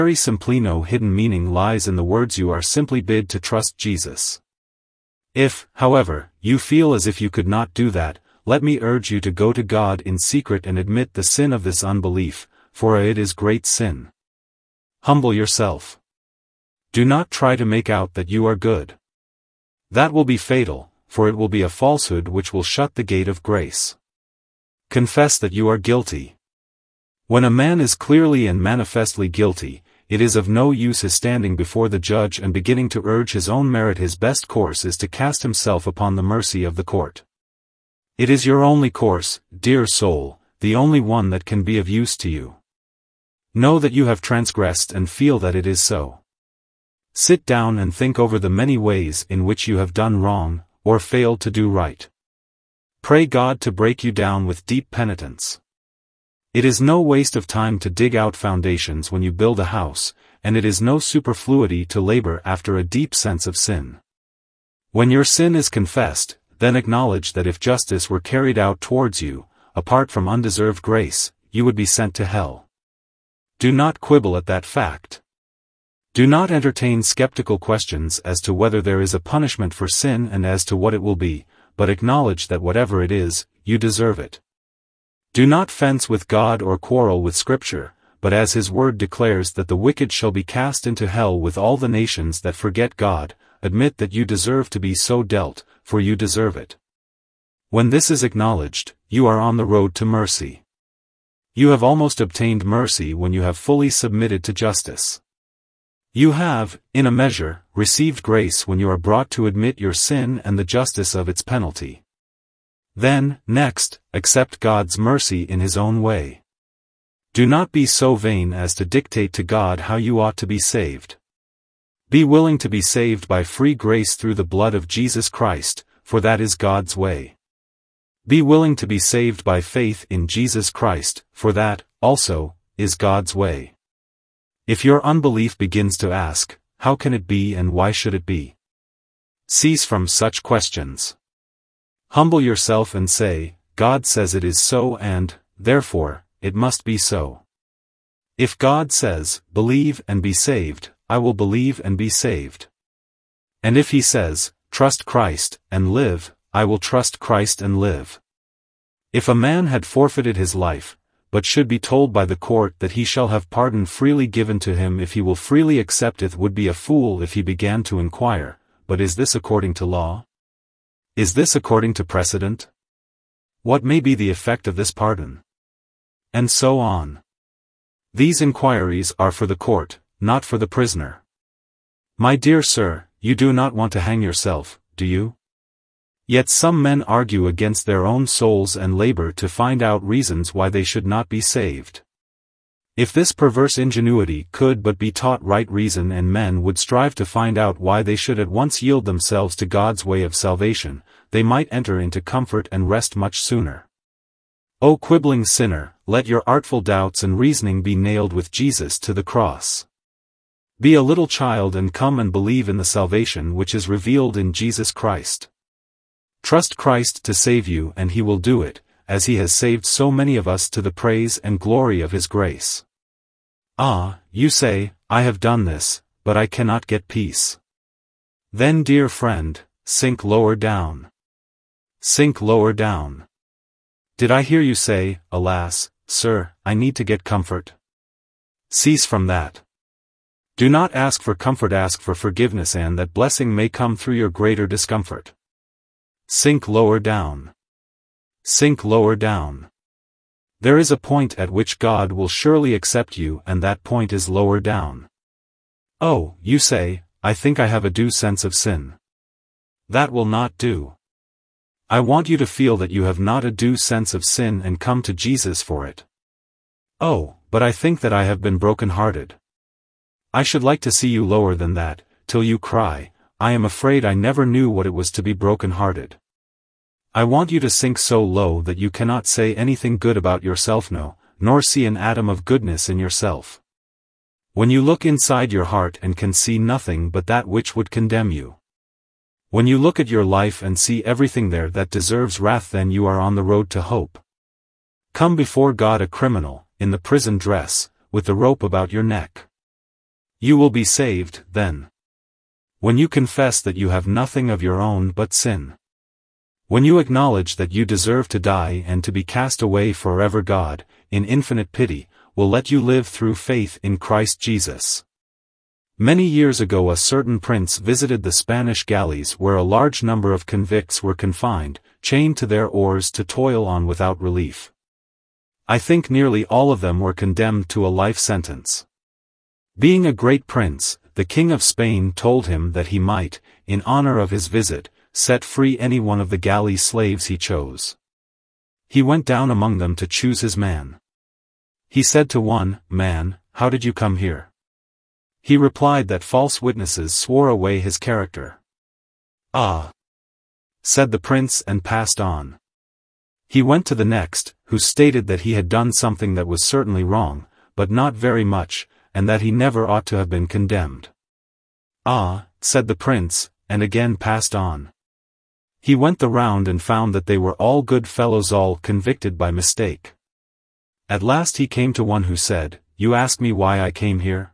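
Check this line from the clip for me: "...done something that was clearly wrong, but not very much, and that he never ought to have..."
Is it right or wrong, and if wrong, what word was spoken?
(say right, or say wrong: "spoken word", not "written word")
wrong: "certainly", not "clearly".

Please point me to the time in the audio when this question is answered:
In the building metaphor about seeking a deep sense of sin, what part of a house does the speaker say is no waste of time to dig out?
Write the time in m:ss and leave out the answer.
0:58.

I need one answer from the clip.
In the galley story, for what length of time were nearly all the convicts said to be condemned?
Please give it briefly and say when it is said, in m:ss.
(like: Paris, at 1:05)
Life sentence, at 5:28.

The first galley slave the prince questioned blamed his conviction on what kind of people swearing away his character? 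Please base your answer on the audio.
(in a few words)
False witnesses.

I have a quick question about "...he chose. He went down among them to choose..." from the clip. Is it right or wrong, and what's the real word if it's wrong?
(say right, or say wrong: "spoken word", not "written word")
right.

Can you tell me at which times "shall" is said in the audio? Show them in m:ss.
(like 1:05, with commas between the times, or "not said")
1:30, 2:43.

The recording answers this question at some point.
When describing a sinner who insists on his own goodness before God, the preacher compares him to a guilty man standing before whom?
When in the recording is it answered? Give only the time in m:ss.
0:31.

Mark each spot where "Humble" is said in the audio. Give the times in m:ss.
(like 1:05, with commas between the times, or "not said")
0:15, 2:22.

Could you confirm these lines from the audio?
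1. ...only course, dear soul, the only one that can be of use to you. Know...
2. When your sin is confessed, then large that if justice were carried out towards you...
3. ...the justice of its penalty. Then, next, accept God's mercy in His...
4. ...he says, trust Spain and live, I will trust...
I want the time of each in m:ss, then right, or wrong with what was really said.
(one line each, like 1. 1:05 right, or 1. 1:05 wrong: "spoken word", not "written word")
1. 0:38 right
2. 1:04 wrong: "acknowledge", not "large"
3. 1:50 right
4. 2:33 wrong: "Christ", not "Spain".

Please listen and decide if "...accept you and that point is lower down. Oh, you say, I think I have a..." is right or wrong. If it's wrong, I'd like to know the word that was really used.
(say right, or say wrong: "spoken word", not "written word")
right.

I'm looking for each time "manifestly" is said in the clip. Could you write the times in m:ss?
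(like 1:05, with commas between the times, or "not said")
0:28.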